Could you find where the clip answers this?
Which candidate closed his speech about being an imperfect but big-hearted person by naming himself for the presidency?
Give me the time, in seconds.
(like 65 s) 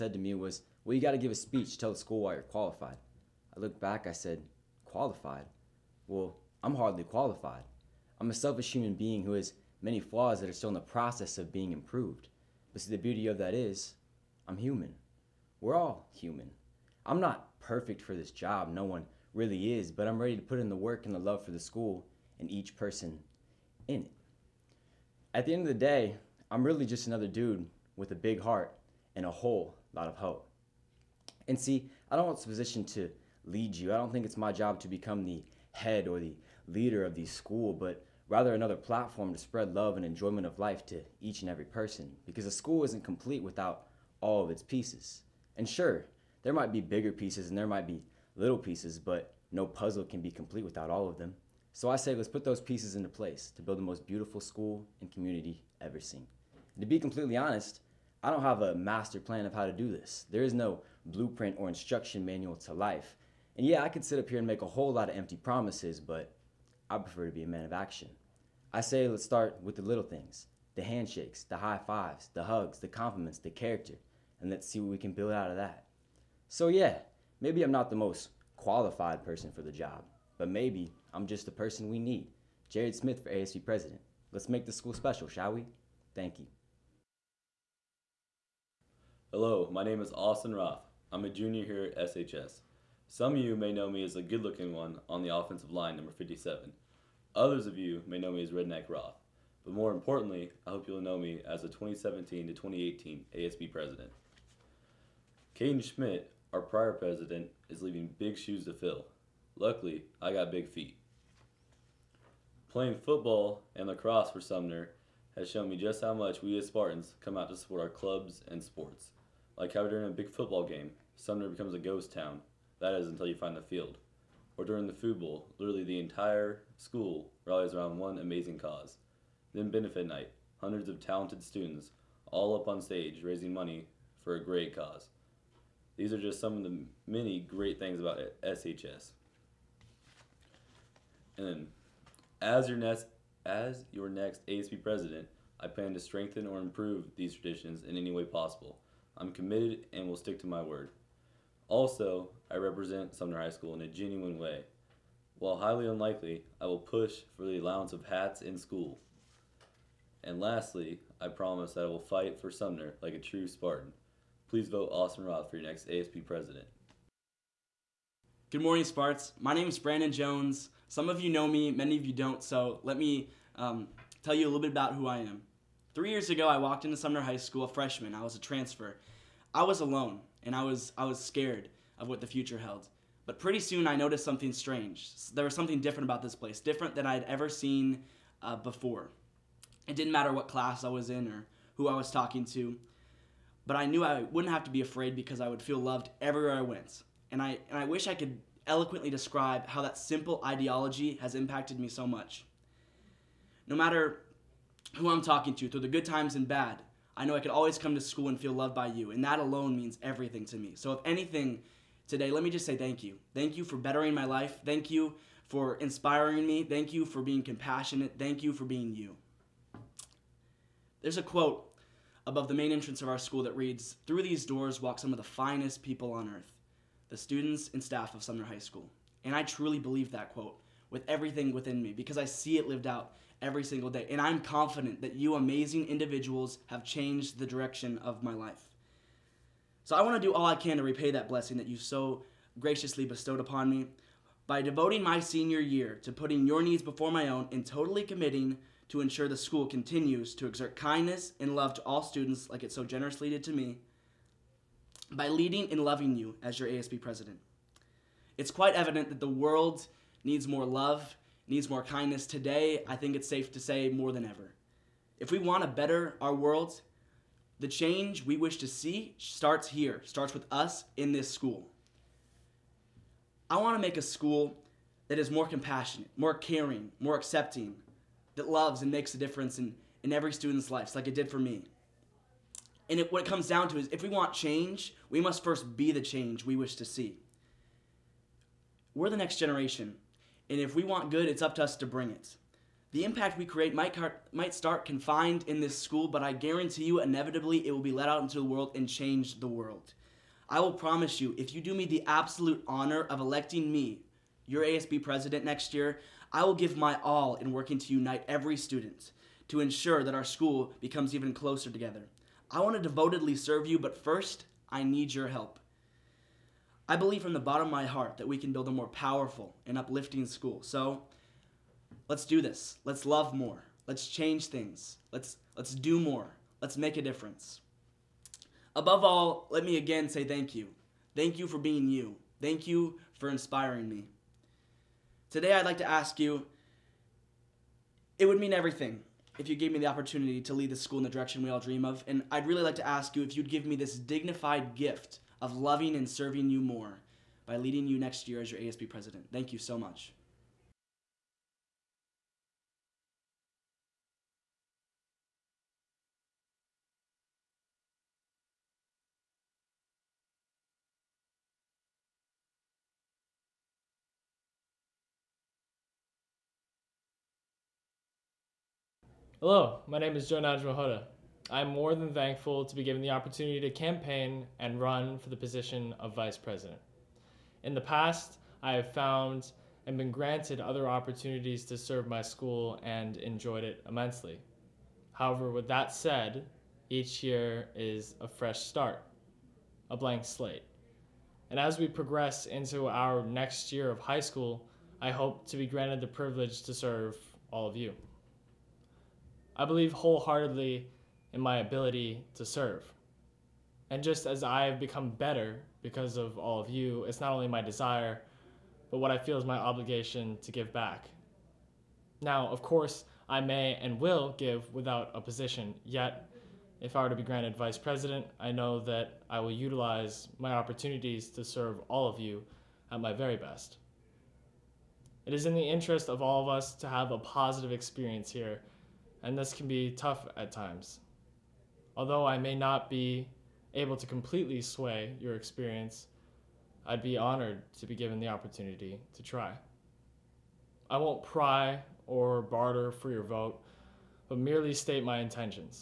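82 s.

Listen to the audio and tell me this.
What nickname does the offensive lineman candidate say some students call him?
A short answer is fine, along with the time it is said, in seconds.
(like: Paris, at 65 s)
Redneck Roth, at 98 s.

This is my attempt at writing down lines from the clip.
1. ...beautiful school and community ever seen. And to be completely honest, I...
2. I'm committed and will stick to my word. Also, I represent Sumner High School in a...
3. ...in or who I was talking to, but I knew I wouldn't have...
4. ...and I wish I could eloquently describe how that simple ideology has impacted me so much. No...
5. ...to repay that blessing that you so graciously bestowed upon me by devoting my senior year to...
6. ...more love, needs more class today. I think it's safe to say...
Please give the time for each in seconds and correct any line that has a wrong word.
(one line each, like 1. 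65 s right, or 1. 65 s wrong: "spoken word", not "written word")
1. 54 s right
2. 149 s right
3. 191 s right
4. 197 s right
5. 240 s right
6. 260 s wrong: "kindness", not "class".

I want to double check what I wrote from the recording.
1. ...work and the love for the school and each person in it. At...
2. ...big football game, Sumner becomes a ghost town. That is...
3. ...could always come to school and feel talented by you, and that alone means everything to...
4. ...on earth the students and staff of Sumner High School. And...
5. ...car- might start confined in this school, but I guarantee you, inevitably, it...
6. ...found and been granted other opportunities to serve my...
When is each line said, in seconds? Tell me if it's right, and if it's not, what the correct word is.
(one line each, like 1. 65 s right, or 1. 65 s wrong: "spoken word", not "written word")
1. 20 s right
2. 120 s right
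3. 207 s wrong: "loved", not "talented"
4. 226 s right
5. 293 s right
6. 378 s right.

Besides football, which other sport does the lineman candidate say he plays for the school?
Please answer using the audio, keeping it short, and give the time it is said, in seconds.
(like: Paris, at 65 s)
lacrosse, at 113 s.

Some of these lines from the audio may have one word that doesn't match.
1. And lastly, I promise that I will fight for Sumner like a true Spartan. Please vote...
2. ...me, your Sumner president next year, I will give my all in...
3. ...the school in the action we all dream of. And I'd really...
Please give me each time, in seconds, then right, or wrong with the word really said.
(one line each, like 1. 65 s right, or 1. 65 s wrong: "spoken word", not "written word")
1. 160 s right
2. 303 s wrong: "ASB", not "Sumner"
3. 340 s wrong: "direction", not "action".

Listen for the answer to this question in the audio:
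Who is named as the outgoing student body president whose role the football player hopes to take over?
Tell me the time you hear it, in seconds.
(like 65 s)
105 s.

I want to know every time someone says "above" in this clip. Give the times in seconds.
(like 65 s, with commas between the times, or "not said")
222 s, 328 s.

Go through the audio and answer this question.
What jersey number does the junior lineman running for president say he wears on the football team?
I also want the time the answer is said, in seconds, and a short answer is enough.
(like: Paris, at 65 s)
57, at 96 s.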